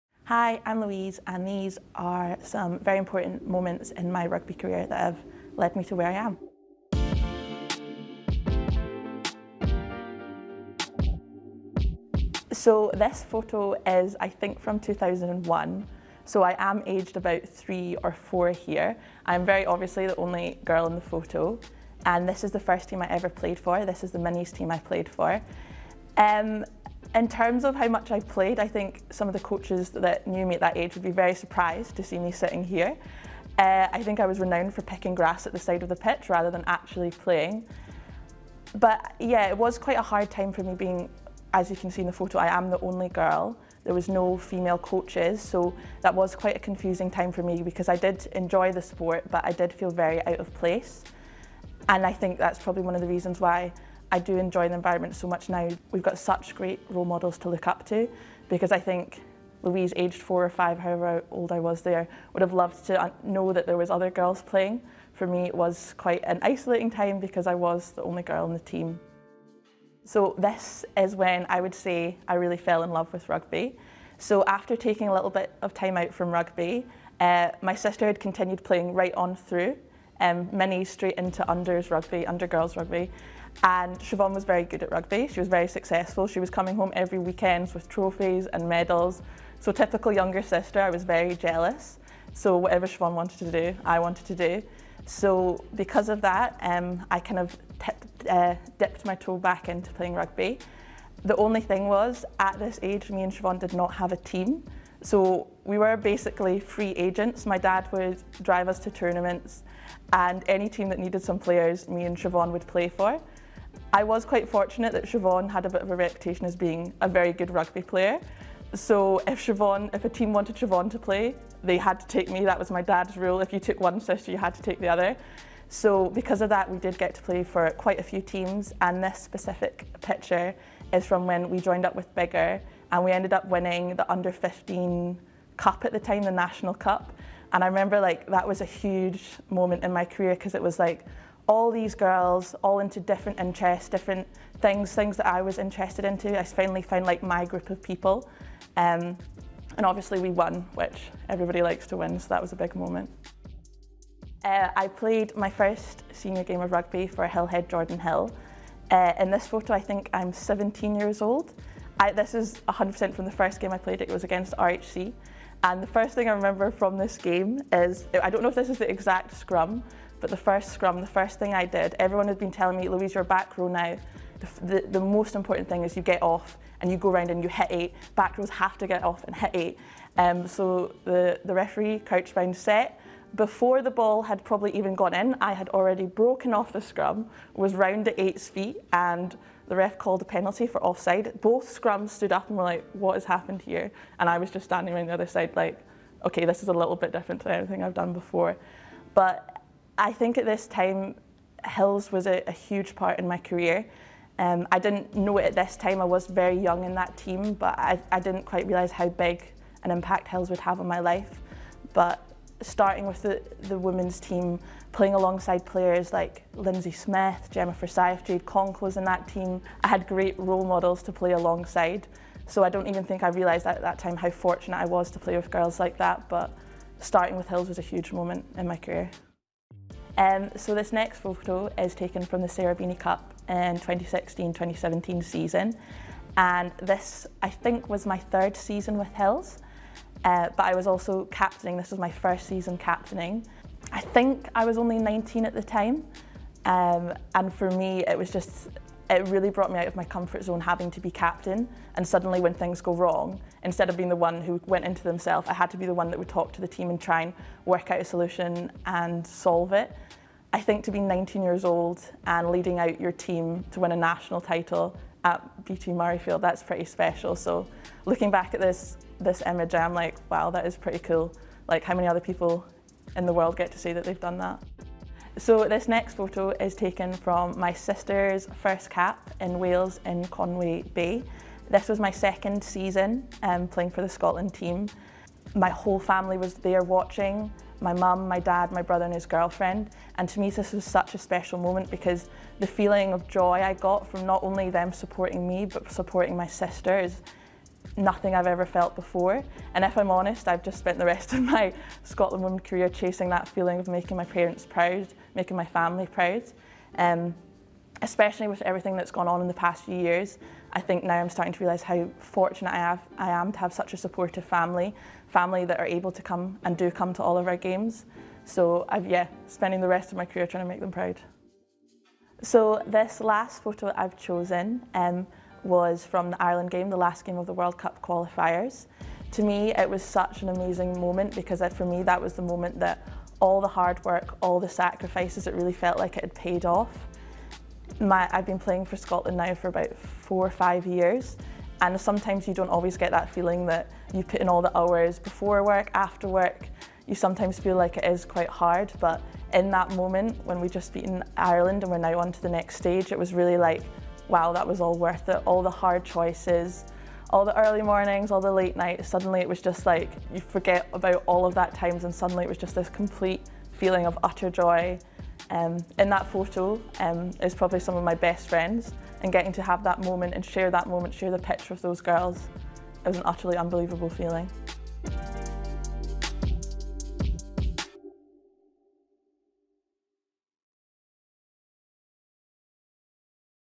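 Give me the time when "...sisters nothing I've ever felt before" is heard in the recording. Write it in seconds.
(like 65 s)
296 s.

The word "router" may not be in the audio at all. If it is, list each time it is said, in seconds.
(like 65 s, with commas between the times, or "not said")
not said.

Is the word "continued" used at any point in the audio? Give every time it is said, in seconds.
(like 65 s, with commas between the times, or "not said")
78 s.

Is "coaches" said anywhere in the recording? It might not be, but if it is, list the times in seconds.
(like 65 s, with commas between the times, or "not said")
29 s, 44 s.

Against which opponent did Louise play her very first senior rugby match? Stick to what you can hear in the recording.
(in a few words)
RHC.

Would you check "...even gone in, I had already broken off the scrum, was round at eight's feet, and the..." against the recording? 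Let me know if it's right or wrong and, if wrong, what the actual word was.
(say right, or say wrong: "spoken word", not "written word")
right.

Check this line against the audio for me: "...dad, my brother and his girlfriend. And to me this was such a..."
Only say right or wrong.
right.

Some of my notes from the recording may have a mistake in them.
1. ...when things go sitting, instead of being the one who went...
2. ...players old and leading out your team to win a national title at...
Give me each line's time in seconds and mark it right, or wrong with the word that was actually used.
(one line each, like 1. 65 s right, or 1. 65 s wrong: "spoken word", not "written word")
1. 252 s wrong: "wrong", not "sitting"
2. 261 s wrong: "years", not "players".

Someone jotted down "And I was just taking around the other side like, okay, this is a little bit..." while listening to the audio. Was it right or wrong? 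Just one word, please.
wrong.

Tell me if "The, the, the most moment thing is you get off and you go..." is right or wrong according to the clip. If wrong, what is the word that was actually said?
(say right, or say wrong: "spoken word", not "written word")
wrong: "important", not "moment".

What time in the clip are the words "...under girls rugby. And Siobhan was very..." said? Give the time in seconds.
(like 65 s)
82 s.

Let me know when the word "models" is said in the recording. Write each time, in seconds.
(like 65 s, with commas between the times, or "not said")
57 s, 220 s.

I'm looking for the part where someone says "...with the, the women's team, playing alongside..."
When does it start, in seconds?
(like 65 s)
213 s.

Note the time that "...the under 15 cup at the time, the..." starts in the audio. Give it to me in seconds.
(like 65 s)
133 s.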